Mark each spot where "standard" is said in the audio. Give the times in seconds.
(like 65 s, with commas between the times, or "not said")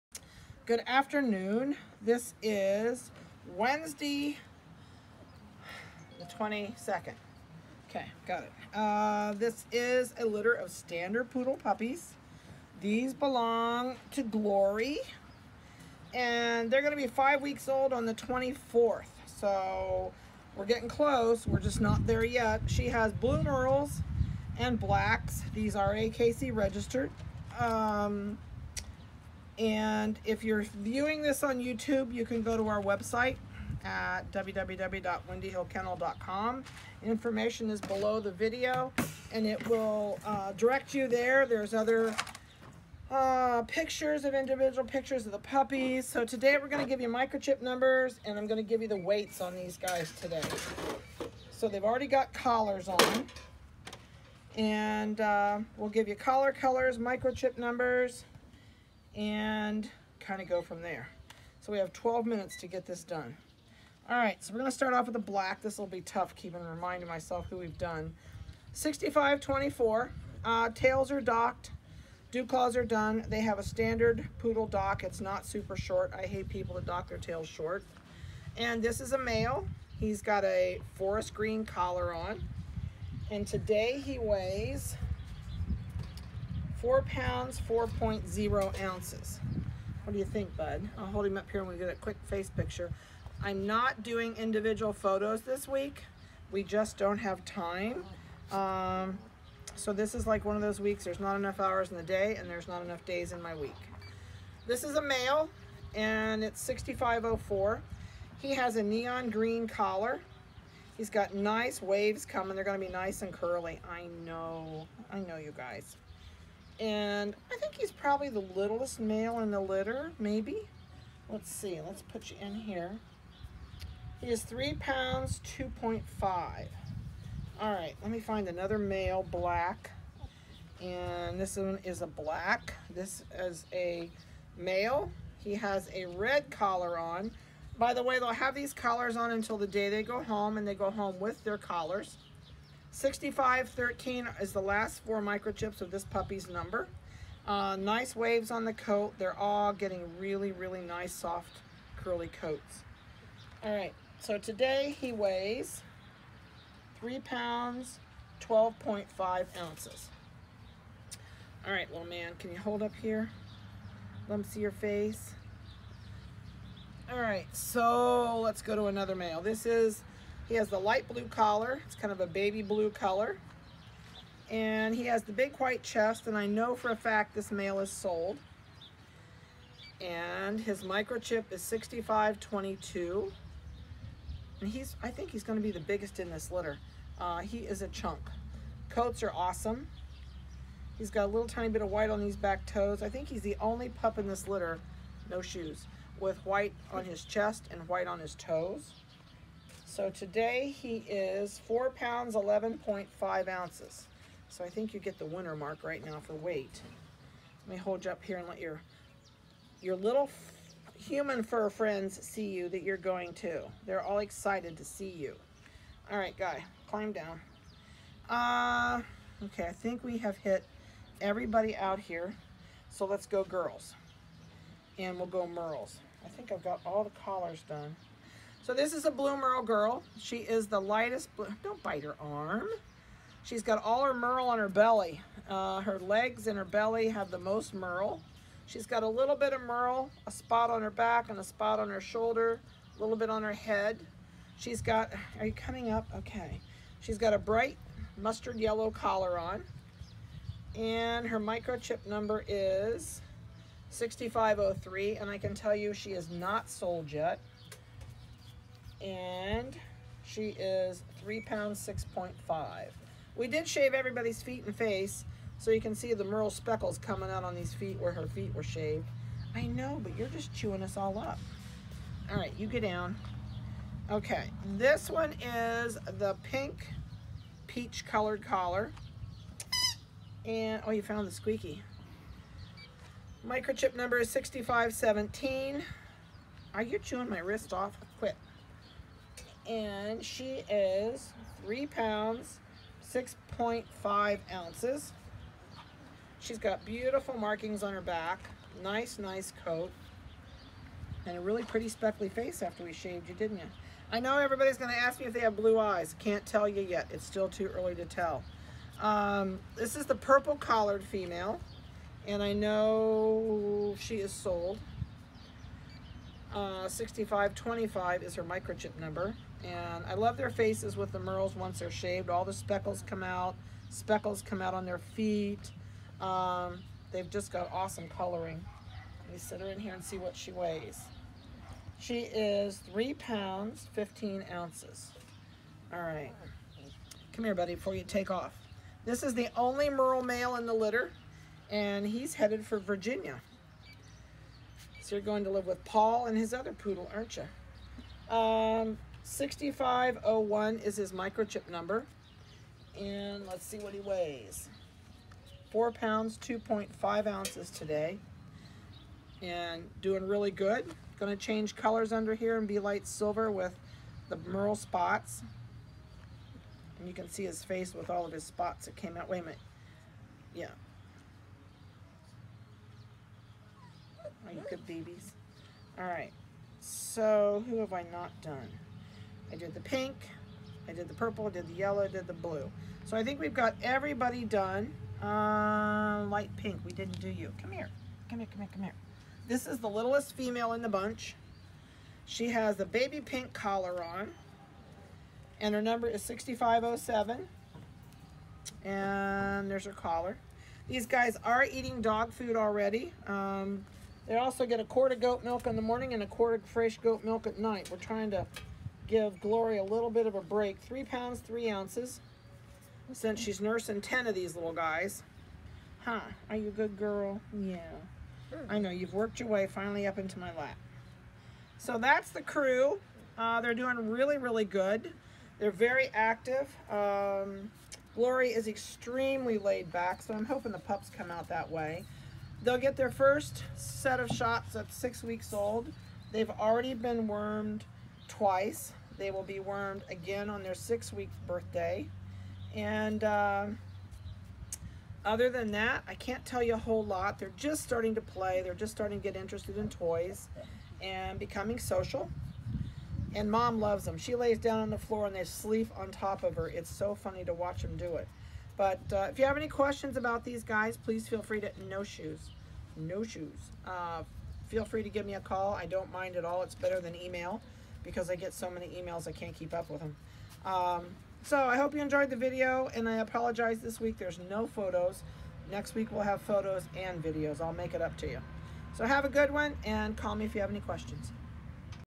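10 s, 73 s.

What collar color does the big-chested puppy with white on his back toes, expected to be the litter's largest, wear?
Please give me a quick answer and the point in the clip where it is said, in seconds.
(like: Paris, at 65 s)
light blue, at 170 s.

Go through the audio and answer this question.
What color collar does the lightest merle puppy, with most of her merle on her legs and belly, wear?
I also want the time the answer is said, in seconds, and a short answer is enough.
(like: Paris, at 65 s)
mustard yellow, at 247 s.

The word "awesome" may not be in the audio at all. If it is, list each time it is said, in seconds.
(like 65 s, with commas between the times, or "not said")
189 s, 327 s.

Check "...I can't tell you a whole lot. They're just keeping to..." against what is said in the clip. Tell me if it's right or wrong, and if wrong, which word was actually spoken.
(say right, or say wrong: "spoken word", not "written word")
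wrong: "starting", not "keeping".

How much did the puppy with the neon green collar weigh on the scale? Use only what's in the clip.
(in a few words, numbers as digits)
3 pounds 2.5 ounces.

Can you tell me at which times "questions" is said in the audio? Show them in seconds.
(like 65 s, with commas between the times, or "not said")
459 s, 480 s.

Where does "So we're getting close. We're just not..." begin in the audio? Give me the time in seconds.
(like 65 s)
19 s.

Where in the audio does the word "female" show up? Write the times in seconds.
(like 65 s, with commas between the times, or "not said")
311 s, 390 s.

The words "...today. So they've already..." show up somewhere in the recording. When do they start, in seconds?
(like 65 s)
50 s.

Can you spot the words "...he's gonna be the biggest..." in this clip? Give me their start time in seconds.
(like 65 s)
185 s.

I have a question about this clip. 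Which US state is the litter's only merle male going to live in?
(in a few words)
Virginia.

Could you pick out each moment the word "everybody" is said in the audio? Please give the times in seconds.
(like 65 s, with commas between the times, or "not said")
221 s, 263 s, 304 s, 383 s.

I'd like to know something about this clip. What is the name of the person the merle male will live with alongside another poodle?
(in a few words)
Paul.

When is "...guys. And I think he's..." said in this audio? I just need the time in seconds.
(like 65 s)
115 s.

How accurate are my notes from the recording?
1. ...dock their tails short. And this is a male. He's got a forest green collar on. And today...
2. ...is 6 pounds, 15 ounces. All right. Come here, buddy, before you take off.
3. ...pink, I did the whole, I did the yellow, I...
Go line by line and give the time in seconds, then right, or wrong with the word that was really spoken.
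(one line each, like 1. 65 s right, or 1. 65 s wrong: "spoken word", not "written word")
1. 76 s right
2. 332 s wrong: "3", not "6"
3. 379 s wrong: "purple", not "whole".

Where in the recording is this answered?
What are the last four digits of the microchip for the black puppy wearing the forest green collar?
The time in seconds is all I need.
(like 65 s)
68 s.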